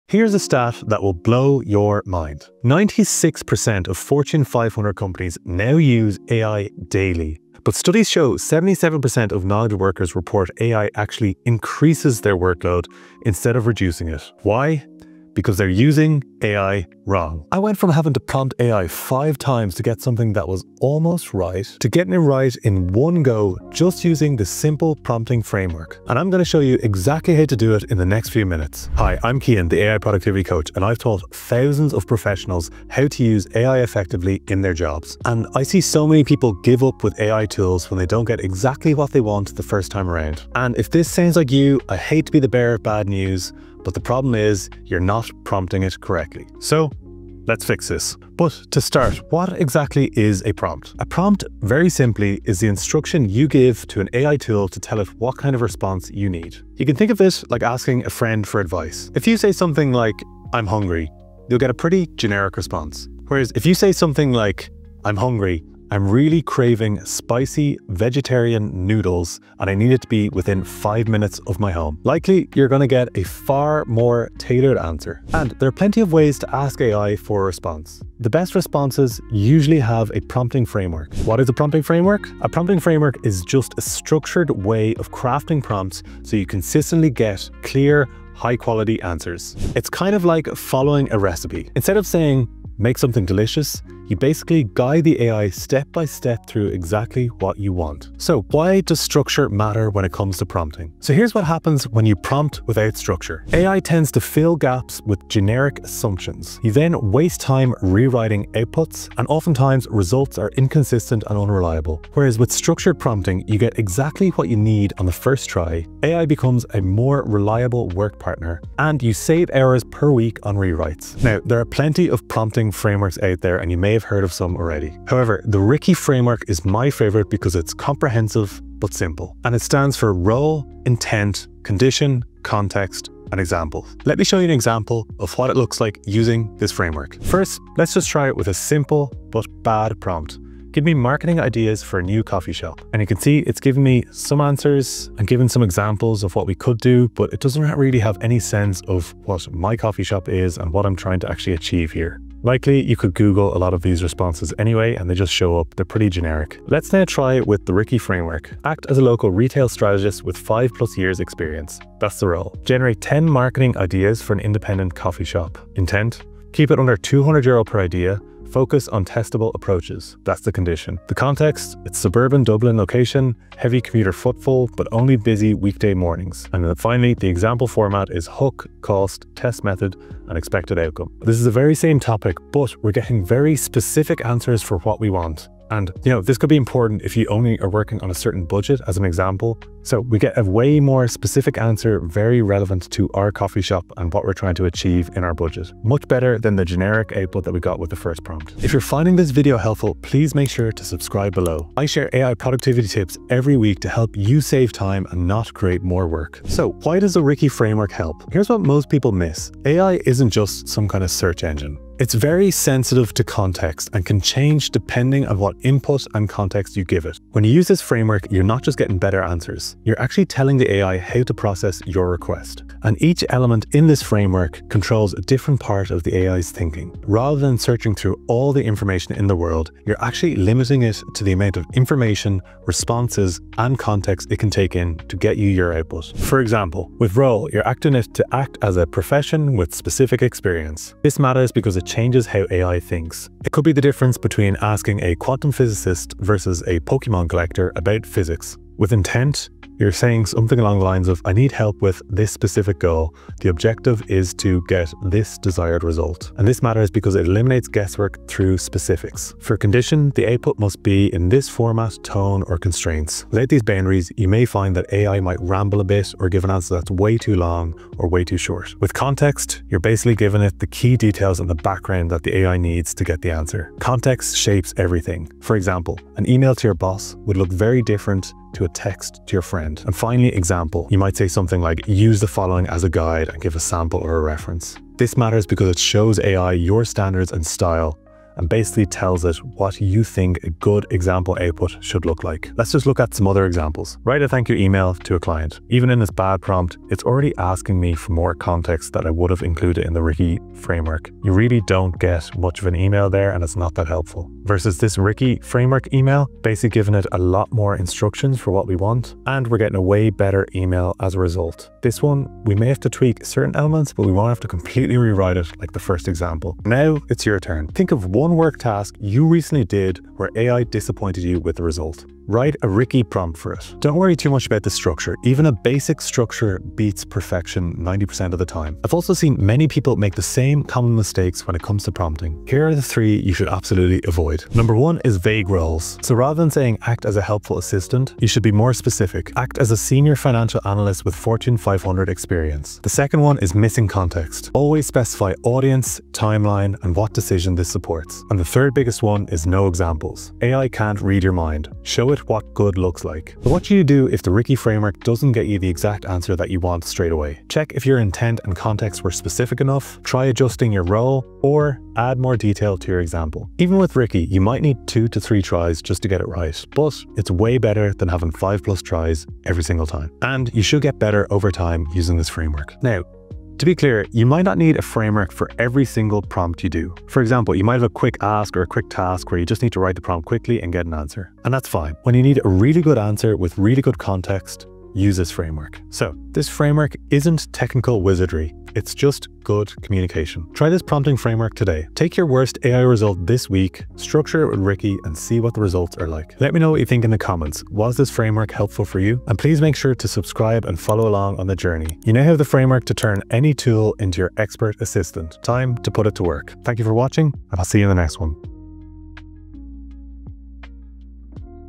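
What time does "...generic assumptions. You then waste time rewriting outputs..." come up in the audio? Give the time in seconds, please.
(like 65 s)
105 s.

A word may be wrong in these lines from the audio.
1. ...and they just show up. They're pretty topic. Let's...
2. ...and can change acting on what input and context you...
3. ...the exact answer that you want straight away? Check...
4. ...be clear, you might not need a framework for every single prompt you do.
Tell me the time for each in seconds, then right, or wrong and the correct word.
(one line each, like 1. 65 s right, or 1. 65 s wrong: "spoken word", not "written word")
1. 154 s wrong: "generic", not "topic"
2. 213 s wrong: "depending", not "acting"
3. 355 s right
4. 373 s right.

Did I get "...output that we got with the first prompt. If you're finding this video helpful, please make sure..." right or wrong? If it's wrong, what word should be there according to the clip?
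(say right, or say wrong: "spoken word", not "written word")
right.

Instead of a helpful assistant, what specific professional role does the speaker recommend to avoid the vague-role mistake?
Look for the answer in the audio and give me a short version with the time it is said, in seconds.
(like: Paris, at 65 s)
senior financial analyst, at 339 s.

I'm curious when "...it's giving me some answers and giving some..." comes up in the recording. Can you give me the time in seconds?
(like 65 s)
143 s.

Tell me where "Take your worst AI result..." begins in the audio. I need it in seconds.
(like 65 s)
391 s.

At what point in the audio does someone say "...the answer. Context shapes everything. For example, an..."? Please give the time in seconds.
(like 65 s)
273 s.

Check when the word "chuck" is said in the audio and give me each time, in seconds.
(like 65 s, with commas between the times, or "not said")
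not said.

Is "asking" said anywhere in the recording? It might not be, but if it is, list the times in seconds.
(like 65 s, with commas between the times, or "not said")
57 s, 244 s, 297 s.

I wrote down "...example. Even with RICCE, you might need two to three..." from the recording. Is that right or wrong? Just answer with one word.
right.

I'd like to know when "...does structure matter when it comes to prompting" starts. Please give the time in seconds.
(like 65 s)
98 s.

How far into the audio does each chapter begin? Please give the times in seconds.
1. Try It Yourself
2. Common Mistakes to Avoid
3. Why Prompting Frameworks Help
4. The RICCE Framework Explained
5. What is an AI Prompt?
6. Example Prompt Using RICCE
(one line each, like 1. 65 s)
1. 317 s
2. 329 s
3. 206 s
4. 121 s
5. 48 s
6. 134 s.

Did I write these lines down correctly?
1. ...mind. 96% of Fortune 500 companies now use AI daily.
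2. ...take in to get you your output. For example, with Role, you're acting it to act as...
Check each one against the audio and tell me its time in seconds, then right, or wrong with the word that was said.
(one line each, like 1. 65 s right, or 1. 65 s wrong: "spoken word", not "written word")
1. 2 s right
2. 234 s right.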